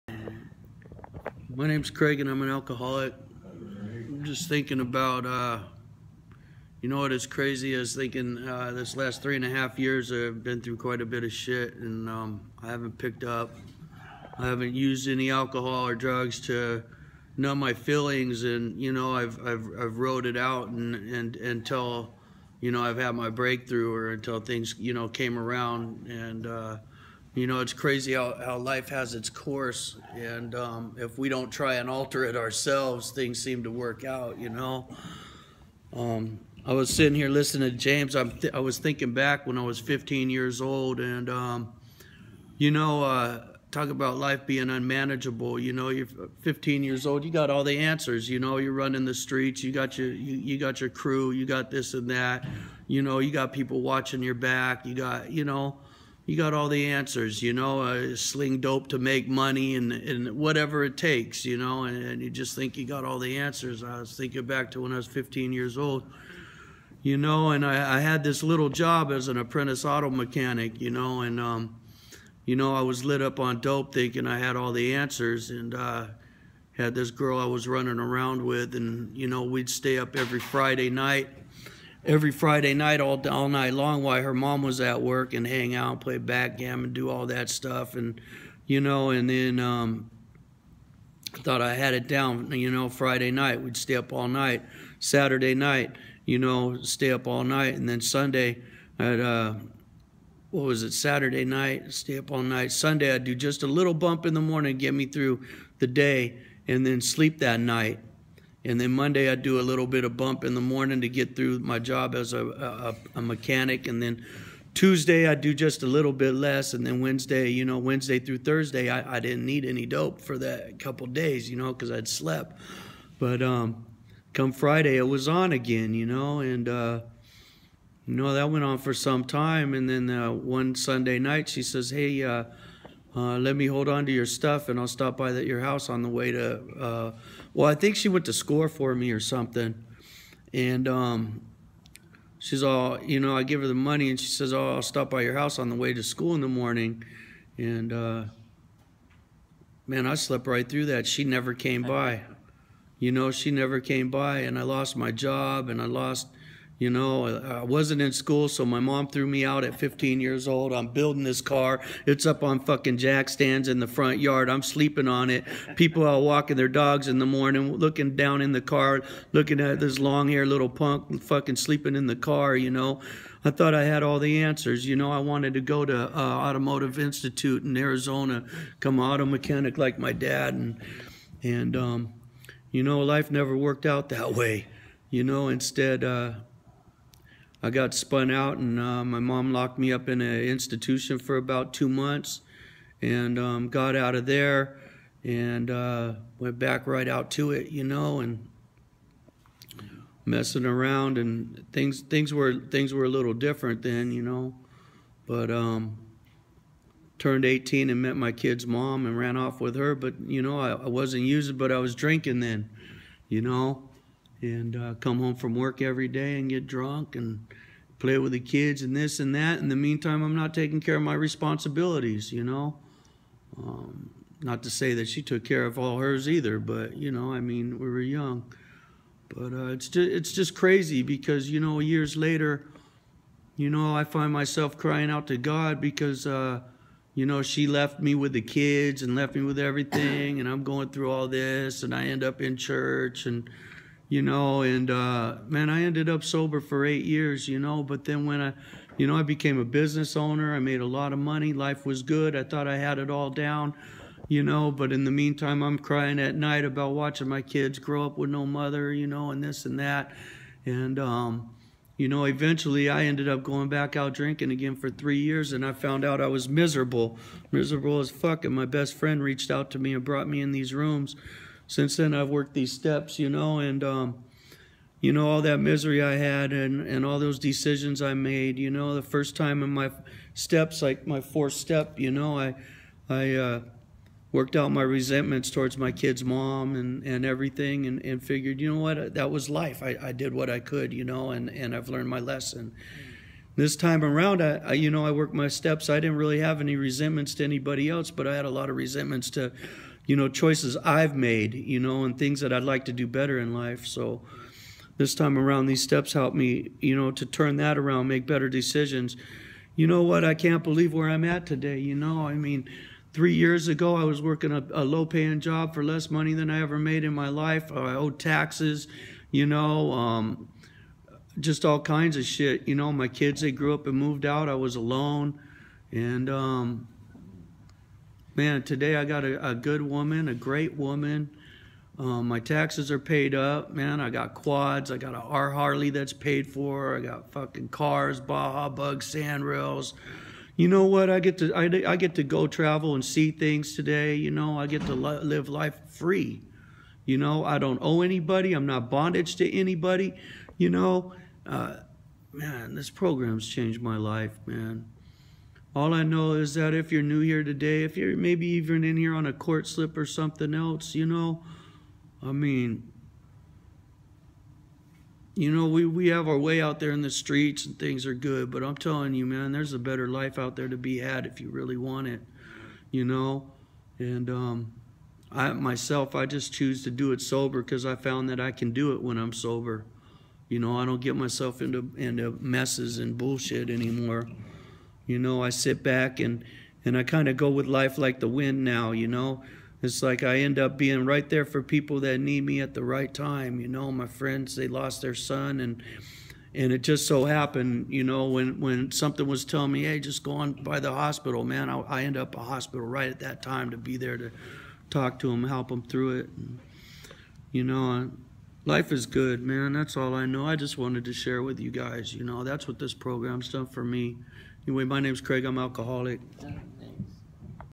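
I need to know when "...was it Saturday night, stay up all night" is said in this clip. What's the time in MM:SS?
01:40.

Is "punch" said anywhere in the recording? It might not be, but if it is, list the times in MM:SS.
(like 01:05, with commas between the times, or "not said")
not said.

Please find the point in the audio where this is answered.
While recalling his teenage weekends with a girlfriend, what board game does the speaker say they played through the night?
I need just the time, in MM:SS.
01:26.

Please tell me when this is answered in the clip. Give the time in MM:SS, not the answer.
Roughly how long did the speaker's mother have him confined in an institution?
03:11.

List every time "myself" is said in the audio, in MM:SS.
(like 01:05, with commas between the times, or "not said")
03:54, 06:15, 06:21.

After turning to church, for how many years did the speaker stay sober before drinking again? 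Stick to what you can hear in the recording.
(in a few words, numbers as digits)
8 years.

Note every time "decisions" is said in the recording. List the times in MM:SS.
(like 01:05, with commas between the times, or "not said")
04:37, 05:08.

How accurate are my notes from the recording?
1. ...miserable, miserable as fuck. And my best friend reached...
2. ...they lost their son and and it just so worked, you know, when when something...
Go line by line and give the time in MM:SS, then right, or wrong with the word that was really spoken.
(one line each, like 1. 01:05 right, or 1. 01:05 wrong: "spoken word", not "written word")
1. 04:26 right
2. 06:34 wrong: "happened", not "worked".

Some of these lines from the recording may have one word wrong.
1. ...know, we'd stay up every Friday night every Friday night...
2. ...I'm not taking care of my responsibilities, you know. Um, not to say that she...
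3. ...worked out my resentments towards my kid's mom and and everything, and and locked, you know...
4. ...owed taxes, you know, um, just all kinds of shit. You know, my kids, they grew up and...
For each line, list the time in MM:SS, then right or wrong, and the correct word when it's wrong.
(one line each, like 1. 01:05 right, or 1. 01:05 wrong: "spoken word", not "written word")
1. 01:19 right
2. 03:40 right
3. 04:44 wrong: "figured", not "locked"
4. 05:17 right.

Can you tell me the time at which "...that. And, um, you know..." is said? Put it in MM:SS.
04:19.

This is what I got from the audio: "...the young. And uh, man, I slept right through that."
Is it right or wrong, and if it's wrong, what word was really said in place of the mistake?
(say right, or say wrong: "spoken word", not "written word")
wrong: "morning", not "young".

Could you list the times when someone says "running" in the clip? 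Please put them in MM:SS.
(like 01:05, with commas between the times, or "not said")
00:48, 01:17.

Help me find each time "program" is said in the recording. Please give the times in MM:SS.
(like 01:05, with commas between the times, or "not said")
05:52, 06:52.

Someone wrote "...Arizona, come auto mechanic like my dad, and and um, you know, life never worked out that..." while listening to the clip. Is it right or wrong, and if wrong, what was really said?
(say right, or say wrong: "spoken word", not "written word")
right.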